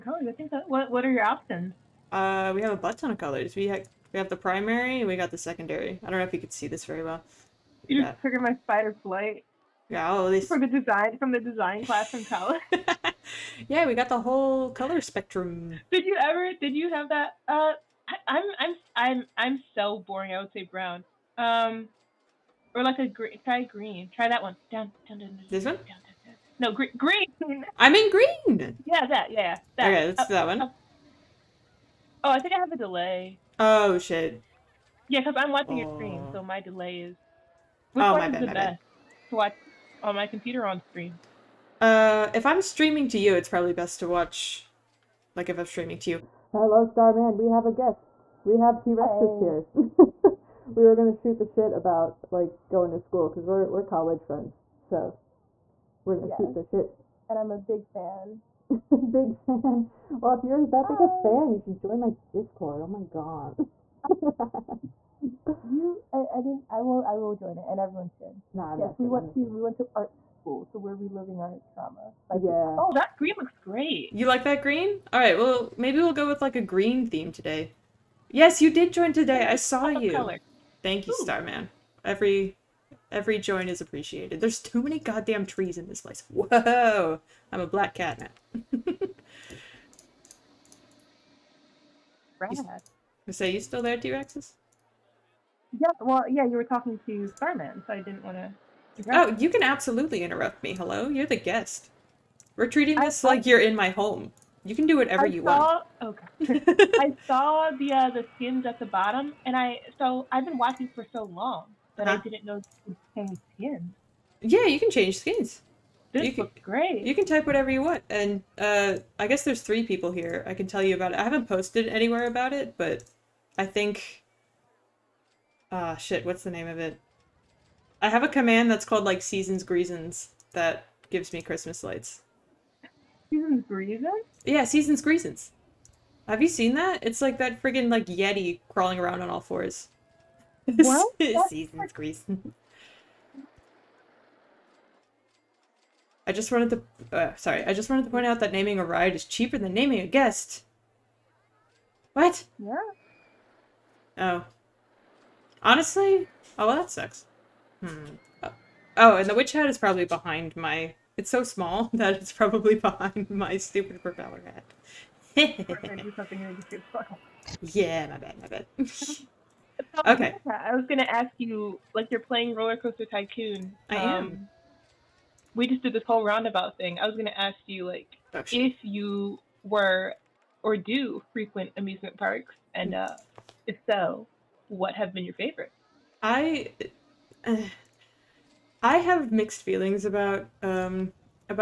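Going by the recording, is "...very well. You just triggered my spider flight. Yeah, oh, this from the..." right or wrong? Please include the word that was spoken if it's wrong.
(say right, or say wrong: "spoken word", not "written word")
right.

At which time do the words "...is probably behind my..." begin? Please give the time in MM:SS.
02:39.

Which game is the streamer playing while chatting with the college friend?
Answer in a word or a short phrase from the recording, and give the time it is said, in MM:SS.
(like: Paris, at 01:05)
Roller Coaster Tycoon, at 02:52.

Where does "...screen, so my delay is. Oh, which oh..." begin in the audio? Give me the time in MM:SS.
00:35.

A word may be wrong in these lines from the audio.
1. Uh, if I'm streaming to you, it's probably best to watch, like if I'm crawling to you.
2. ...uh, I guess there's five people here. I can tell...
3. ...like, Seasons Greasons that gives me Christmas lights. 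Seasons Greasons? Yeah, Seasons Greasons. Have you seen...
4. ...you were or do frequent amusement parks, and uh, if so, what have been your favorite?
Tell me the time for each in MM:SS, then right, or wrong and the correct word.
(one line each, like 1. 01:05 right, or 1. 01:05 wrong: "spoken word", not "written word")
1. 00:41 wrong: "streaming", not "crawling"
2. 01:58 wrong: "three", not "five"
3. 02:09 right
4. 02:58 right.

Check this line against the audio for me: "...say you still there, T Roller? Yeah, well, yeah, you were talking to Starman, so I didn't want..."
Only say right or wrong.
wrong.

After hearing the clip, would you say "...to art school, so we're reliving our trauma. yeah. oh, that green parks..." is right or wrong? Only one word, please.
wrong.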